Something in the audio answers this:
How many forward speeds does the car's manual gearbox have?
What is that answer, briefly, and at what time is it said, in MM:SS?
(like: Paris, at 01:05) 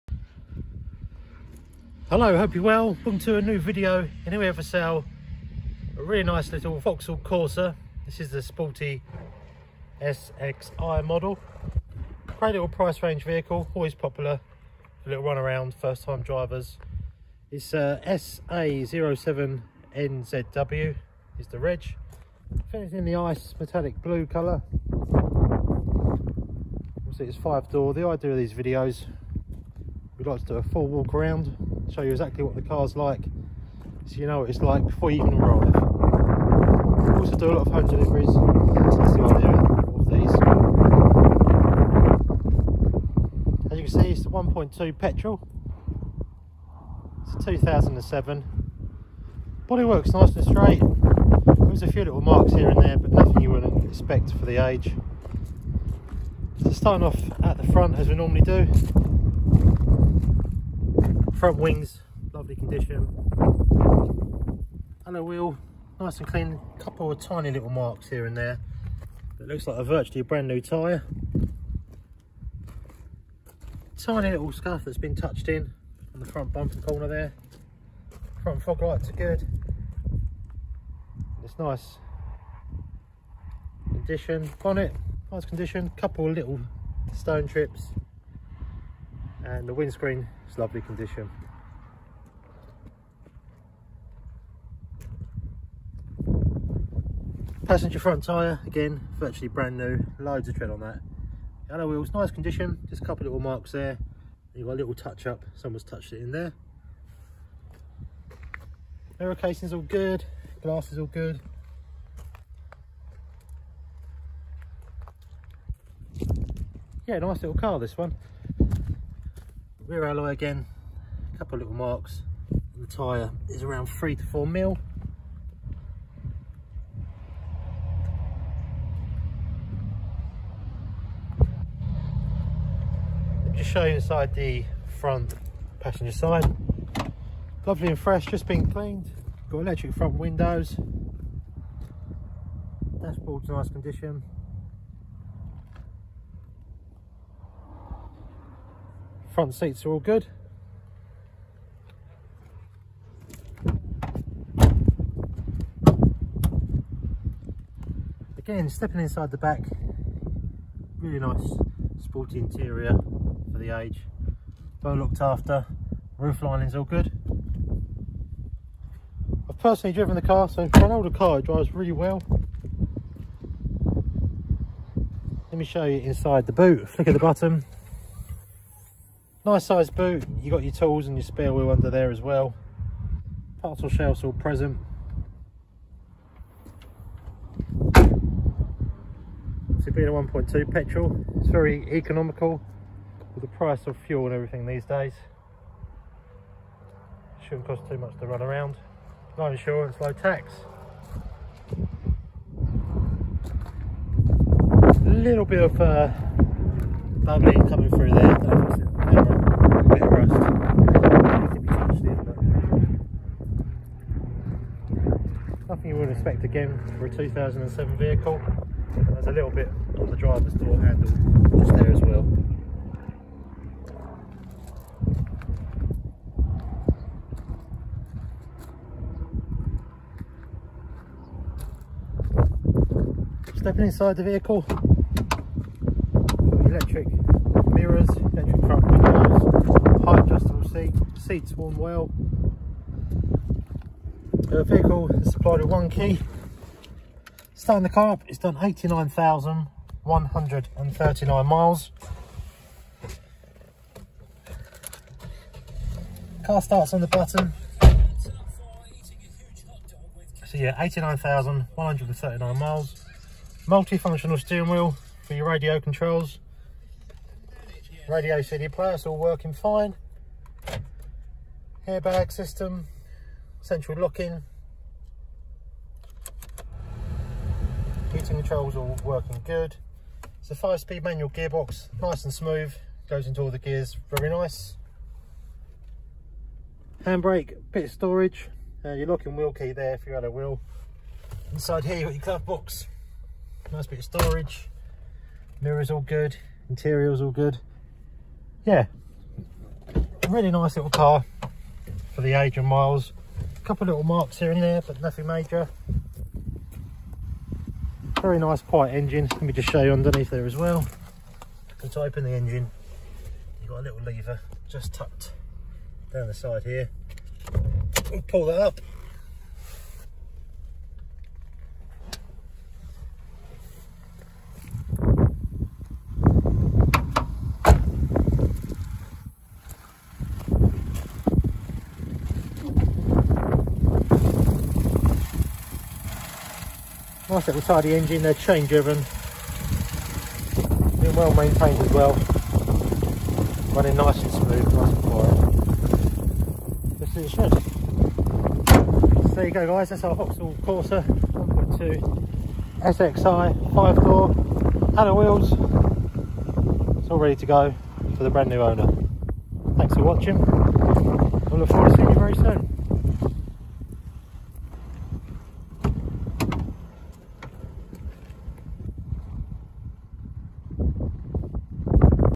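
Five, at 04:40.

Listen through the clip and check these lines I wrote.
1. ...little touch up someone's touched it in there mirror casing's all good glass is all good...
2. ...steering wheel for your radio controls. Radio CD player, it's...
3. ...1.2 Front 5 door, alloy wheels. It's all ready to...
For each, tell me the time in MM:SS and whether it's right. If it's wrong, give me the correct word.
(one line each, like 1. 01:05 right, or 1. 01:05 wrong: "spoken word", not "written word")
1. 01:44 right
2. 04:24 right
3. 05:51 wrong: "SXI", not "Front".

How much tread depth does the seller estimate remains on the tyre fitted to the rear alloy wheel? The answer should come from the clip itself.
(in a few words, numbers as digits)
3 to 4 mm.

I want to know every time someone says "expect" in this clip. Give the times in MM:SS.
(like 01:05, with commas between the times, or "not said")
00:53, 03:36.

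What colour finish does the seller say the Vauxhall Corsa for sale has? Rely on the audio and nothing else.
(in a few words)
Ice metallic blue.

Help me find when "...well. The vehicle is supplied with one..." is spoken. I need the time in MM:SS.
04:01.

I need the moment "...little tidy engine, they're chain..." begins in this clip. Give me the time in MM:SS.
05:37.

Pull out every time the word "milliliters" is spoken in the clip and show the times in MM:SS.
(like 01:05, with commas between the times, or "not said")
not said.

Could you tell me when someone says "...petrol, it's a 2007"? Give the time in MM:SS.
00:44.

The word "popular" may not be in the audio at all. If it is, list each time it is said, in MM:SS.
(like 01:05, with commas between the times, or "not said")
00:13.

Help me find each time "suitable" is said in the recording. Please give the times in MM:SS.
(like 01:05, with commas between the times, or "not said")
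not said.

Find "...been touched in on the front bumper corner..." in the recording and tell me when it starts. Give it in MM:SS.
01:14.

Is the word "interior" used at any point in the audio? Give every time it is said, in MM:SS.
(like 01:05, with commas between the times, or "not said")
02:42, 04:56.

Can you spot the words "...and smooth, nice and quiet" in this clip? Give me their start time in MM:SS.
05:44.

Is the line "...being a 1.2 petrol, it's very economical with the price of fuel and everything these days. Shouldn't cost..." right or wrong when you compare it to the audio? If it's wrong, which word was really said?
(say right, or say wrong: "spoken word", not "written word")
right.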